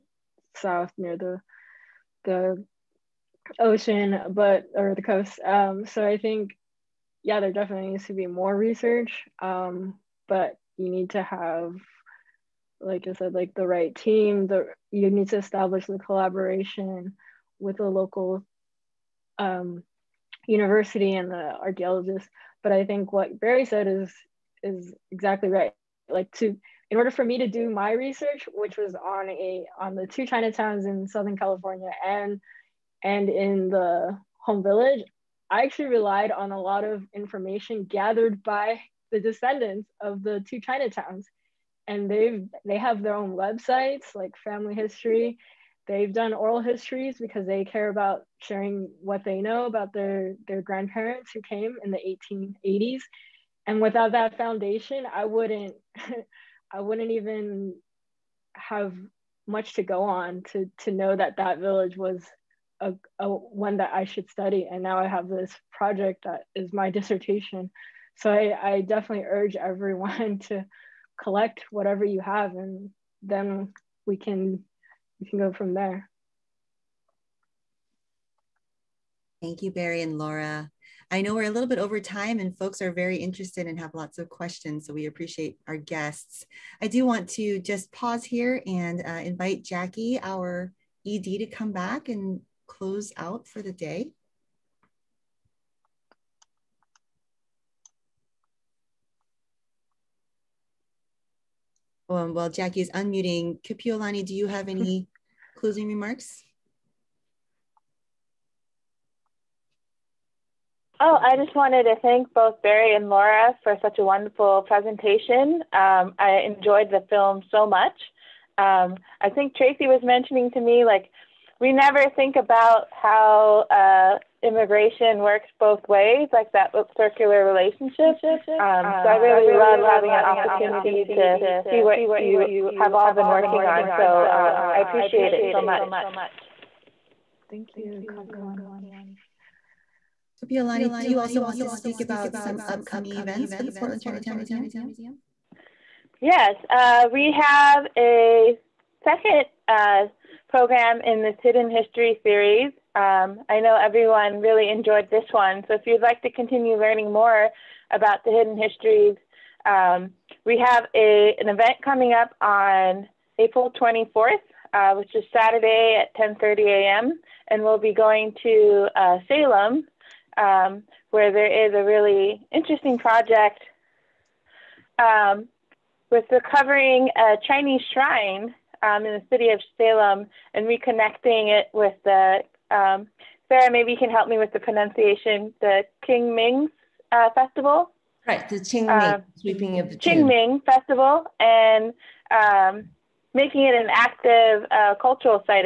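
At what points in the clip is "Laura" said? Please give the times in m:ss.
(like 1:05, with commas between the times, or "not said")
1:20, 1:53.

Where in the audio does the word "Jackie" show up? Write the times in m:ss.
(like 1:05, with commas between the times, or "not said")
1:29, 1:42.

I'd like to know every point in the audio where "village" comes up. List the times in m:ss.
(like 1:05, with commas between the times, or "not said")
0:34, 1:01.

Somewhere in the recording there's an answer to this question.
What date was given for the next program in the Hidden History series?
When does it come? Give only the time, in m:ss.
2:43.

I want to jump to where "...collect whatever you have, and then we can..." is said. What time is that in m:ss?
1:11.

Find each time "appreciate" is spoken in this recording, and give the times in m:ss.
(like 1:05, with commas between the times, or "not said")
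1:25, 2:14.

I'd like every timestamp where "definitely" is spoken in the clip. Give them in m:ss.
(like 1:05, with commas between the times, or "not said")
0:07, 1:08.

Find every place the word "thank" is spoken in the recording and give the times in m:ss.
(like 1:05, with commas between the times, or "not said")
1:19, 1:52, 2:17.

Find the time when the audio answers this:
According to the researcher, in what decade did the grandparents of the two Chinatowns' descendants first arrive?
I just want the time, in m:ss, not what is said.
0:52.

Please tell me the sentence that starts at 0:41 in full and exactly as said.
And they've they have their own websites like family history.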